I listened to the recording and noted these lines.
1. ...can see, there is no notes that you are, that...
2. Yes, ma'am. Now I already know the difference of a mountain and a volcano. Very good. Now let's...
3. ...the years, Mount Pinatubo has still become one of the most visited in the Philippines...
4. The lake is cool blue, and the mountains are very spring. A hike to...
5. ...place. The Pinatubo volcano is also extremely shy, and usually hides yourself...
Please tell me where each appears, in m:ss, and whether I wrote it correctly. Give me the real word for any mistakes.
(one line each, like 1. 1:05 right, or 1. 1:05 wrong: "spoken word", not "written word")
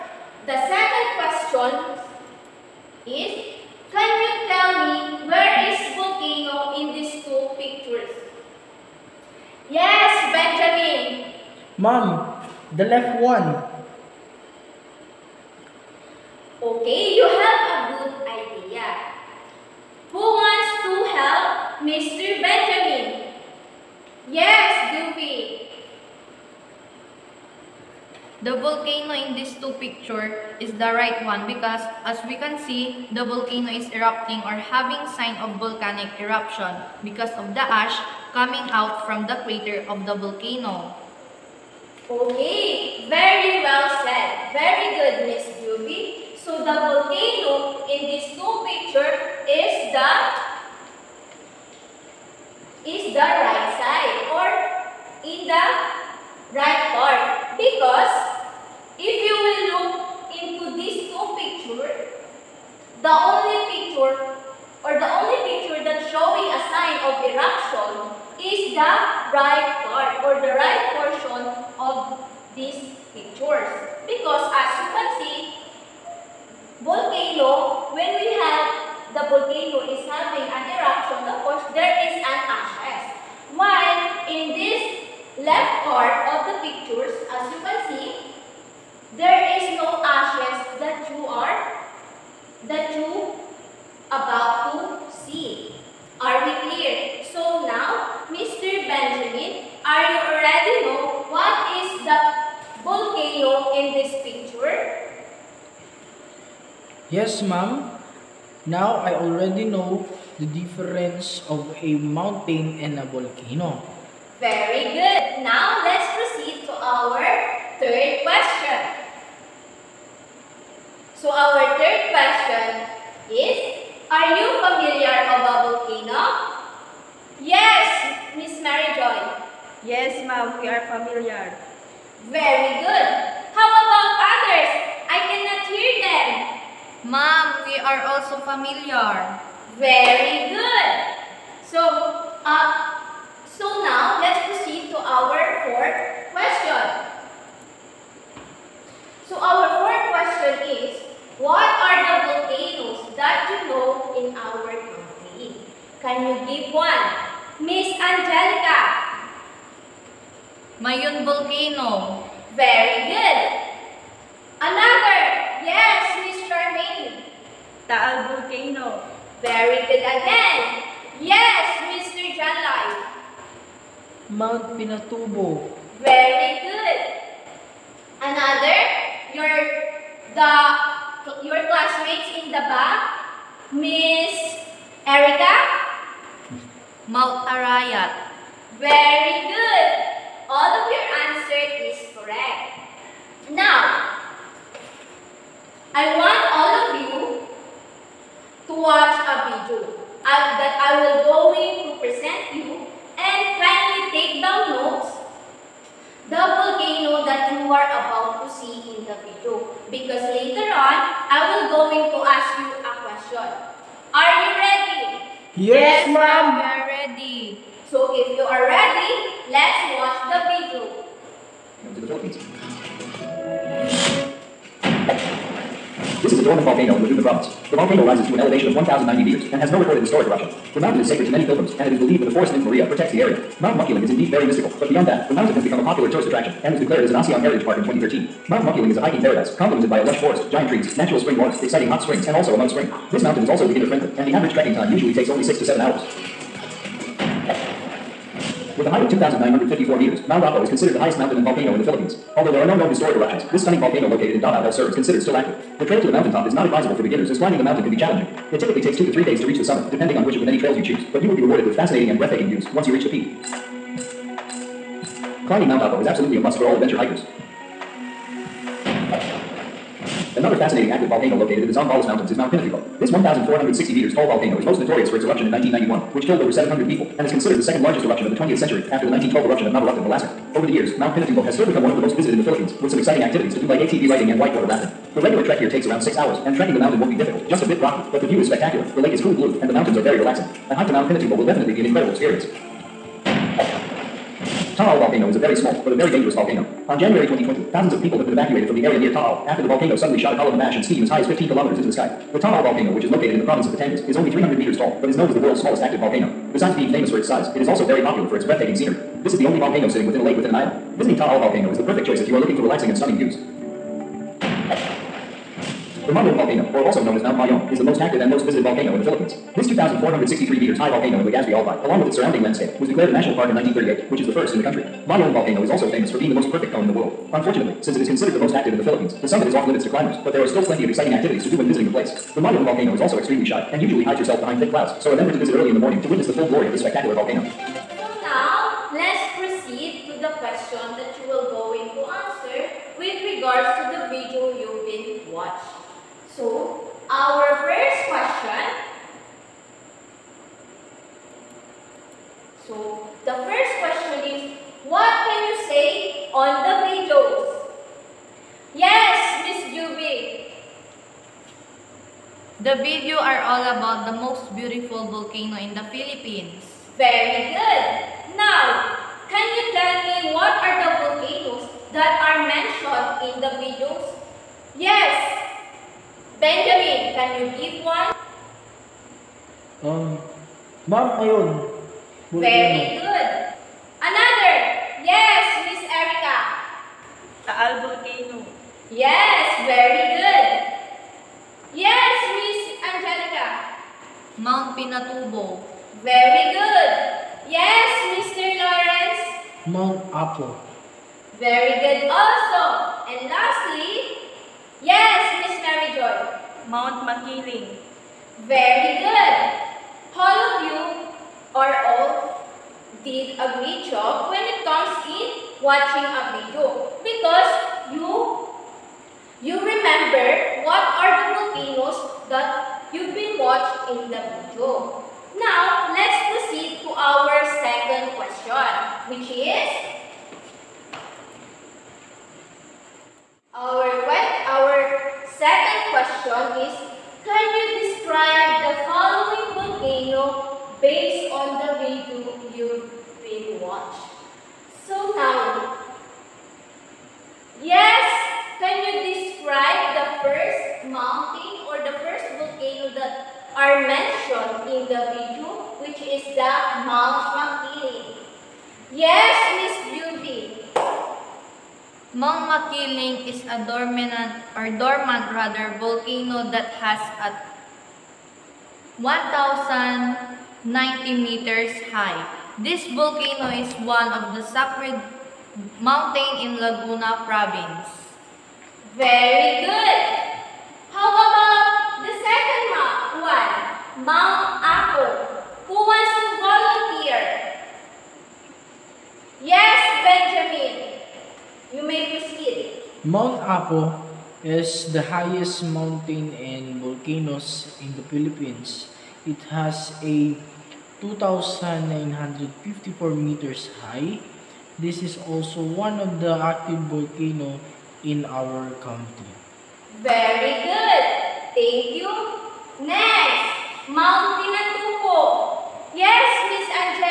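1. 1:27 wrong: "ashes", not "notes"
2. 1:47 right
3. 4:40 right
4. 4:48 wrong: "relaxing", not "spring"
5. 5:31 wrong: "Mayon", not "Pinatubo".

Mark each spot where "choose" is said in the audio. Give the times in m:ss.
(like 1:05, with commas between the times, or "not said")
4:20.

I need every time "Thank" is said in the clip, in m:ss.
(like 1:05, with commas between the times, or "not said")
8:31.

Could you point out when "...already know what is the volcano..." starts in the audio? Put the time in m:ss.
1:40.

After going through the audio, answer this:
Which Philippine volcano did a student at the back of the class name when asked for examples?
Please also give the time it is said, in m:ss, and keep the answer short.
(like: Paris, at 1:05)
Mount Arayat, at 3:07.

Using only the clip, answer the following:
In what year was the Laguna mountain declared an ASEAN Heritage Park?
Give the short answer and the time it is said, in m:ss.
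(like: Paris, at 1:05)
2013, at 3:57.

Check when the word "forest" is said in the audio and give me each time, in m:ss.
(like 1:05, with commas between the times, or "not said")
3:52, 4:00.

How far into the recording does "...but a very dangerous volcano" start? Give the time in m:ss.
4:55.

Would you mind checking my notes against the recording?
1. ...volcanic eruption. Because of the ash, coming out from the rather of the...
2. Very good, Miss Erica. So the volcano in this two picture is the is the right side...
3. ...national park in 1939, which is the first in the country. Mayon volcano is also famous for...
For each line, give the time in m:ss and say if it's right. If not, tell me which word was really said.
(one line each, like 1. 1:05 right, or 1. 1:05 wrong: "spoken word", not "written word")
1. 0:35 wrong: "crater", not "rather"
2. 0:44 wrong: "Ruby", not "Erica"
3. 5:23 wrong: "1938", not "1939".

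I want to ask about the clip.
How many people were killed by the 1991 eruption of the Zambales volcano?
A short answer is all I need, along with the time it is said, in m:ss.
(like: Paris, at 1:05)
over 700, at 4:36.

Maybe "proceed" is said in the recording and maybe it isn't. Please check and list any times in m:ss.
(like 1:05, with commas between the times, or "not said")
1:56, 2:24, 5:39, 7:06.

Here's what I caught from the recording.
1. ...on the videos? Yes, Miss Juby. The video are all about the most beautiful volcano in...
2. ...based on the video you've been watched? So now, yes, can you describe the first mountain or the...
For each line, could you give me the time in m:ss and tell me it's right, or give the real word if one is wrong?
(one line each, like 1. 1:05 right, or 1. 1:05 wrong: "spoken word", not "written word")
1. 5:56 right
2. 7:20 right.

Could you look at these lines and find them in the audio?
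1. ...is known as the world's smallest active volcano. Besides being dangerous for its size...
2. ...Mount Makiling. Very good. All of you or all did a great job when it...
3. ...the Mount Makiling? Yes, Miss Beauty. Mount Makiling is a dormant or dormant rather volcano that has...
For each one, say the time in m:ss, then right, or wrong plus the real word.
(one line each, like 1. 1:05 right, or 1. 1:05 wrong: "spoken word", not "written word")
1. 5:05 wrong: "famous", not "dangerous"
2. 6:46 right
3. 7:36 right.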